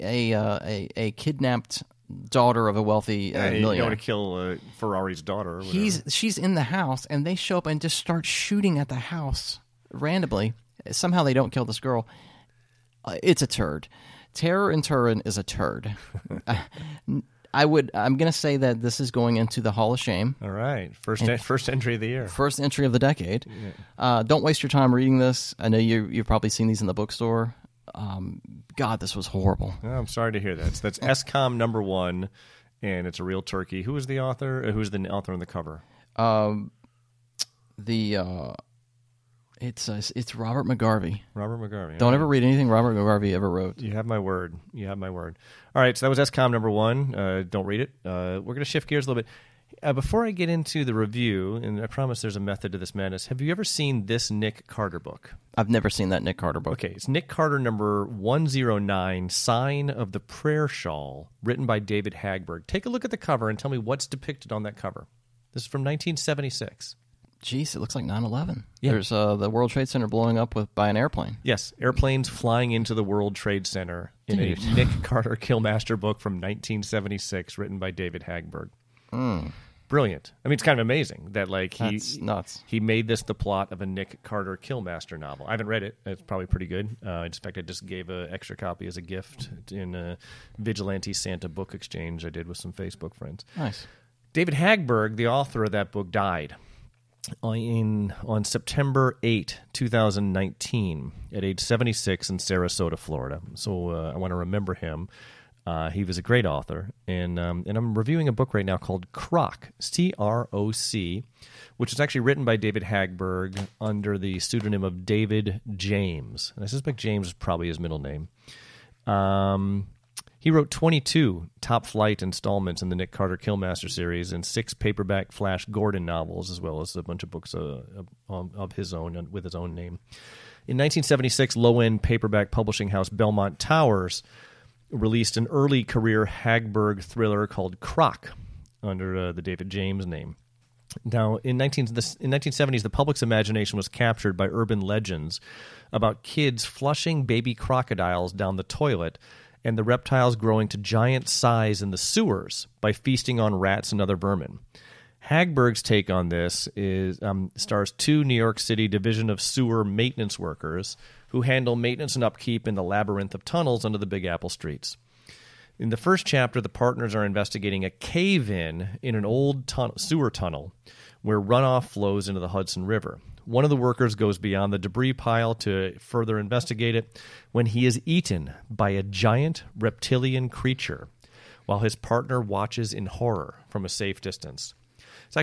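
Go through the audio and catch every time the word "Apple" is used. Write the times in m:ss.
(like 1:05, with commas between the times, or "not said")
2:44.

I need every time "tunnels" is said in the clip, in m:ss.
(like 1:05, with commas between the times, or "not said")
2:43, 2:50.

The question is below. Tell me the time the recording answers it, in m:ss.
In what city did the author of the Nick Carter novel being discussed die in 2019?
1:42.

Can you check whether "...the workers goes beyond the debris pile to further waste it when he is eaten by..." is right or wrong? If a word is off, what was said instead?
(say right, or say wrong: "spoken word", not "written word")
wrong: "investigate", not "waste".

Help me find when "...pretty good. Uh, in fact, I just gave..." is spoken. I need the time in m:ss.
1:26.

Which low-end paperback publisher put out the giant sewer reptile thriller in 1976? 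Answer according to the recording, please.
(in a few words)
Belmont Towers.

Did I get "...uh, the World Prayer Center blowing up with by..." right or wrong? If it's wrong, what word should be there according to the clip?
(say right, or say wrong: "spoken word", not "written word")
wrong: "Trade", not "Prayer".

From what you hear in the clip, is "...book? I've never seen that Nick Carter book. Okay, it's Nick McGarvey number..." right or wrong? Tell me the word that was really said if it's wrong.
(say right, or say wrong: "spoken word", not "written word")
wrong: "Carter", not "McGarvey".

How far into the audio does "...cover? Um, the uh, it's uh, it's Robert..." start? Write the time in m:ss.
0:35.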